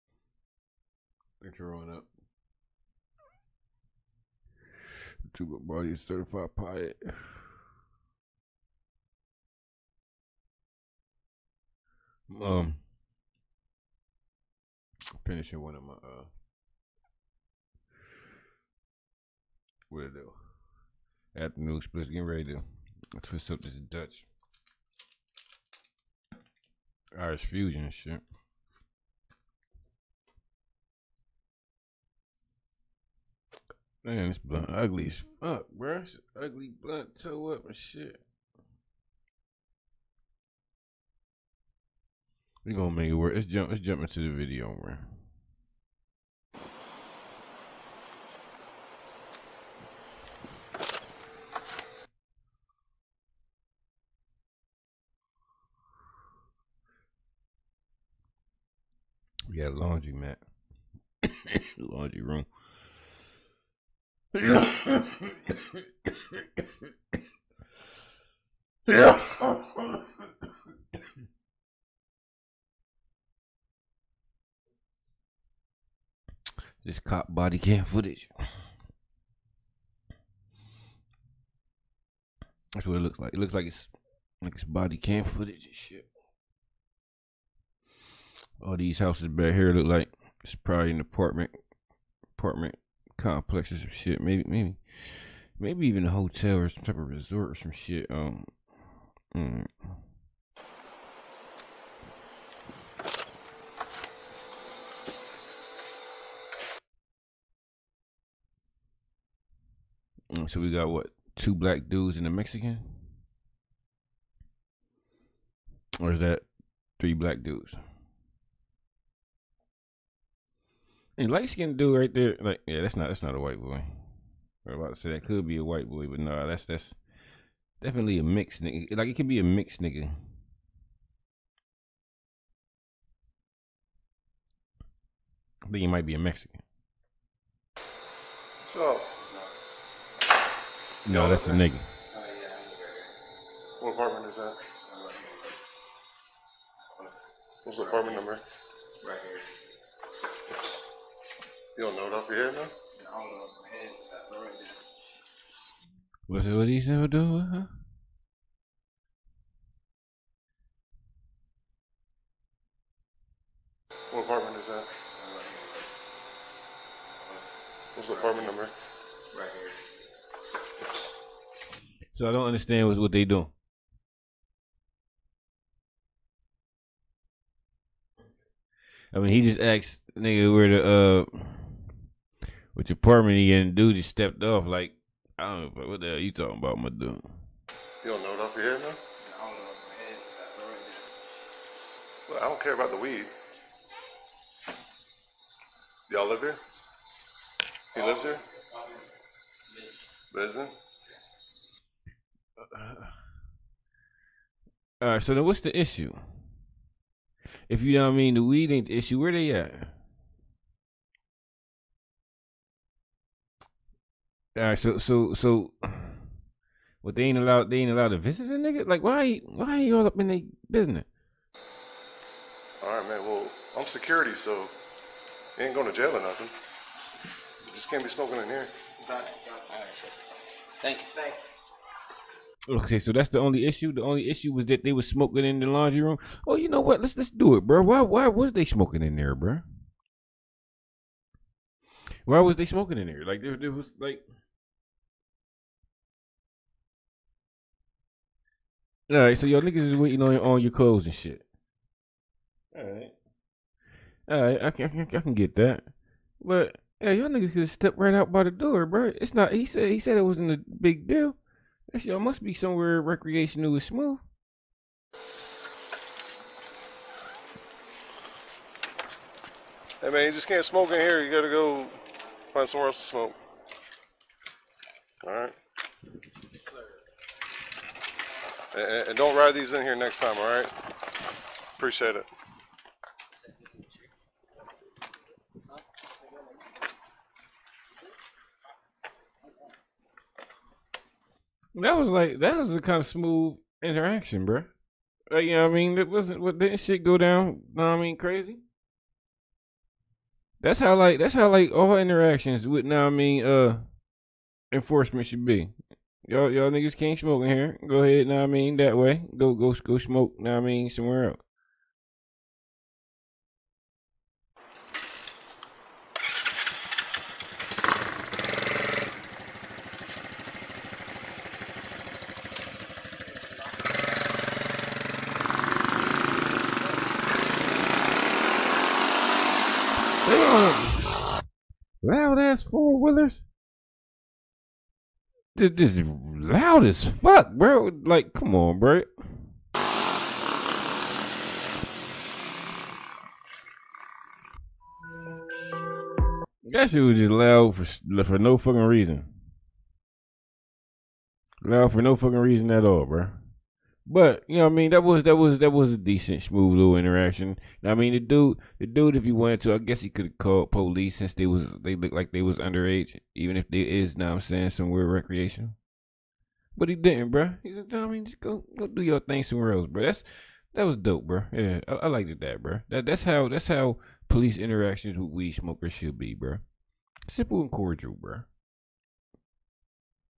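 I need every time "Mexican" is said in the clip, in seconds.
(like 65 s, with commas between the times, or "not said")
112 s, 136 s.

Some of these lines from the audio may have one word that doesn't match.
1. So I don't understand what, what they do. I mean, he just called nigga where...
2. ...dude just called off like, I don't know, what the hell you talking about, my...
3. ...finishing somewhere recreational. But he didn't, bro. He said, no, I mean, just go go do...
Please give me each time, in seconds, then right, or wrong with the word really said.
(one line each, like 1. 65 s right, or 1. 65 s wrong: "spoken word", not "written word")
1. 172 s wrong: "asked", not "called"
2. 183 s wrong: "stepped", not "called"
3. 364 s wrong: "saying", not "finishing".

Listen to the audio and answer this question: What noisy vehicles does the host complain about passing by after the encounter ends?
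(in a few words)
four wheelers.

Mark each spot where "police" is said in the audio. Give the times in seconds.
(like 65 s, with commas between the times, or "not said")
360 s, 374 s.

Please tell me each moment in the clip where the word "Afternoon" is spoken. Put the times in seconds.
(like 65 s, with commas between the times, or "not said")
21 s.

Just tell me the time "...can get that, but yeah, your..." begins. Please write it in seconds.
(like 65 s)
255 s.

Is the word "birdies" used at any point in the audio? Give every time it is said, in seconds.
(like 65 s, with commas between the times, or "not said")
not said.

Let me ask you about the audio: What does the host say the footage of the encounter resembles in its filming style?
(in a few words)
cop body cam footage.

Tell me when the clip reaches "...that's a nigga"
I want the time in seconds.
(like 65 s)
141 s.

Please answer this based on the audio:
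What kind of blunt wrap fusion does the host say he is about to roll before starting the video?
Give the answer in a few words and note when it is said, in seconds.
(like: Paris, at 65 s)
Dutch Irish fusion, at 23 s.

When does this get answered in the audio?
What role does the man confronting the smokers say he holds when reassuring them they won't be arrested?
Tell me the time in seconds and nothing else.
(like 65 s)
223 s.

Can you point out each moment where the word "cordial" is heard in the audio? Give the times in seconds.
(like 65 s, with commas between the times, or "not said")
377 s.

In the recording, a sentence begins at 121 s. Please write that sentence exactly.
And light skinned dude right there, like yeah, that's not that's not a white boy.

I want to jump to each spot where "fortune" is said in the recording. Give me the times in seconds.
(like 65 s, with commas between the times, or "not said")
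not said.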